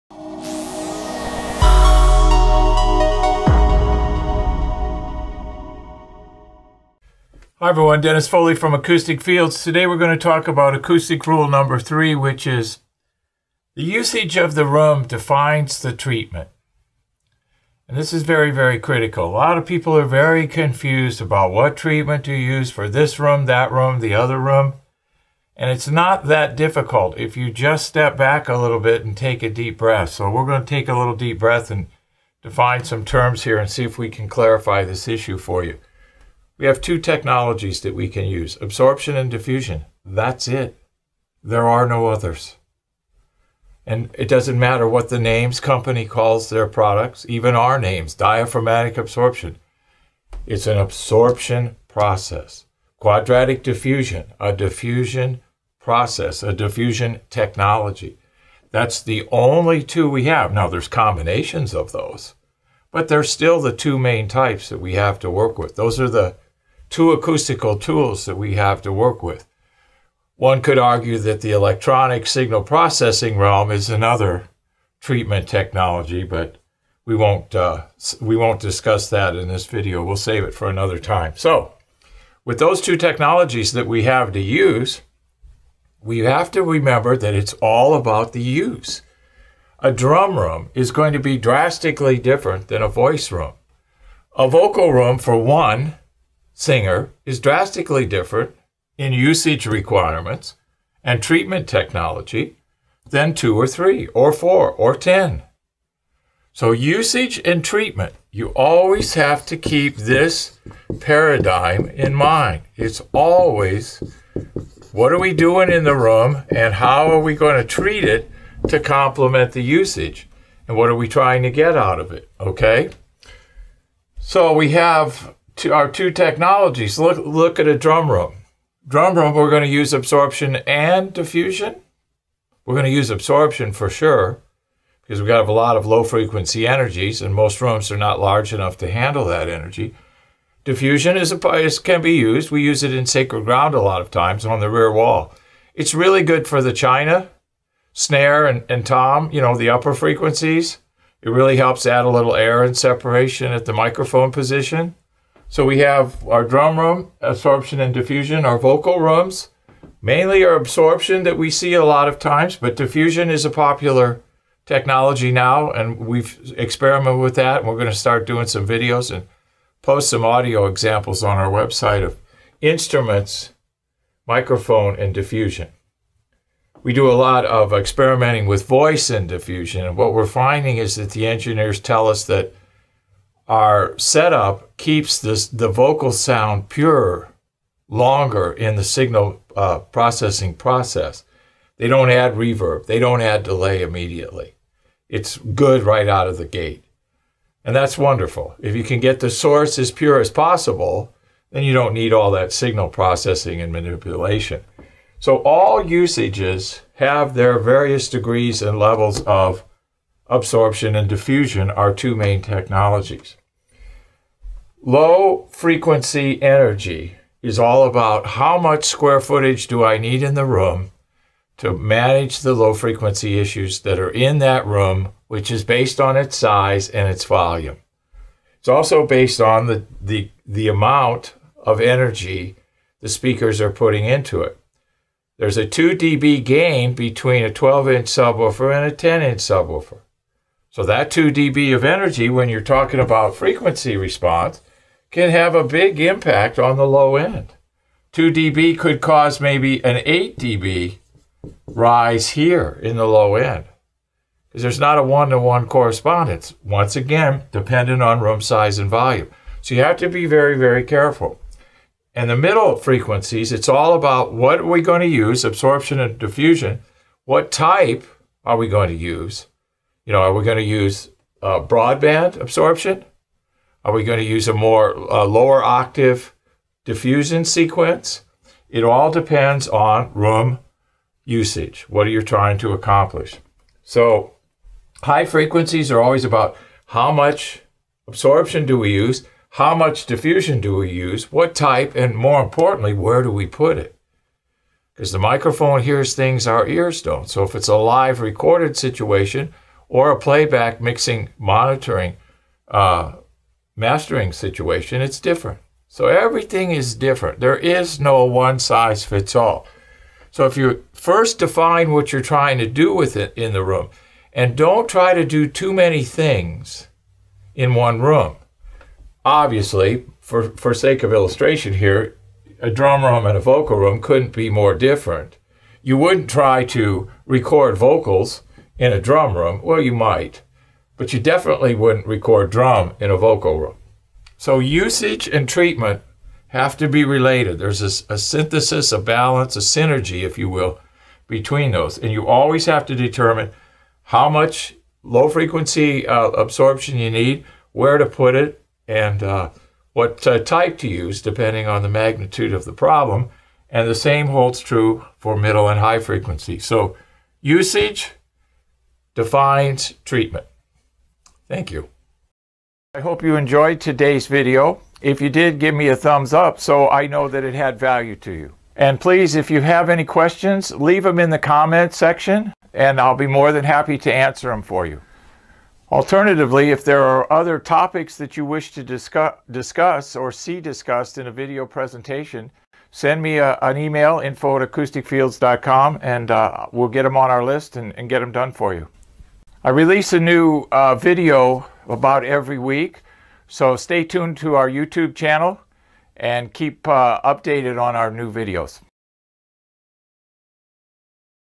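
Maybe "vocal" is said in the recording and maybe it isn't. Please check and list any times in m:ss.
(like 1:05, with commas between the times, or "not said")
1:34, 2:38, 3:05, 5:23, 5:27, 5:33.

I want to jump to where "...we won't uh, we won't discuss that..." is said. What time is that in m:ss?
1:17.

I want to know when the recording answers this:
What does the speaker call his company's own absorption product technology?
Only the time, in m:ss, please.
0:48.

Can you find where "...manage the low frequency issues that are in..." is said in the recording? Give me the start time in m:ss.
3:41.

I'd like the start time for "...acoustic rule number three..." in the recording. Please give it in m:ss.
0:10.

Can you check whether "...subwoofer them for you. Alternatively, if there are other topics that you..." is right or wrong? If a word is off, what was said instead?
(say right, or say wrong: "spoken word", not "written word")
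wrong: "answer", not "subwoofer".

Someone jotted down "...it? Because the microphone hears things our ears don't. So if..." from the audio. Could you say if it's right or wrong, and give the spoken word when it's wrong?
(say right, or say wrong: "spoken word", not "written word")
right.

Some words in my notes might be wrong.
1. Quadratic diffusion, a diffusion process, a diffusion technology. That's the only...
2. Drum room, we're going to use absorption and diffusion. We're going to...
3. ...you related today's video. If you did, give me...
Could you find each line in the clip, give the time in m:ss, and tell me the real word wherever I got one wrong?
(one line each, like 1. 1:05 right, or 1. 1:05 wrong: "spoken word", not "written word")
1. 0:52 right
2. 2:08 right
3. 6:03 wrong: "enjoyed", not "related".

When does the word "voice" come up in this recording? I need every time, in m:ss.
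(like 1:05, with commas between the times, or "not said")
1:32, 2:58.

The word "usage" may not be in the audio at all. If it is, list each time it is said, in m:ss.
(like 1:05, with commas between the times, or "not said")
0:13, 1:39, 1:46, 1:59, 3:25, 4:41, 5:34, 5:57.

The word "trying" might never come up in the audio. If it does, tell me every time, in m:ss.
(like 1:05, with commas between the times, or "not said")
2:01, 4:42, 5:12.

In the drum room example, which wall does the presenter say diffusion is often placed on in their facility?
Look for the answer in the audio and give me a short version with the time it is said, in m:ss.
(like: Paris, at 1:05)
rear wall, at 2:24.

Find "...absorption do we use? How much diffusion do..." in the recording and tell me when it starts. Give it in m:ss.
4:48.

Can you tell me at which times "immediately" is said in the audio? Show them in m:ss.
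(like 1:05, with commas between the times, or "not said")
3:13.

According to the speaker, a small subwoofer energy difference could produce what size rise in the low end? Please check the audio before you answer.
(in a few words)
8 dB.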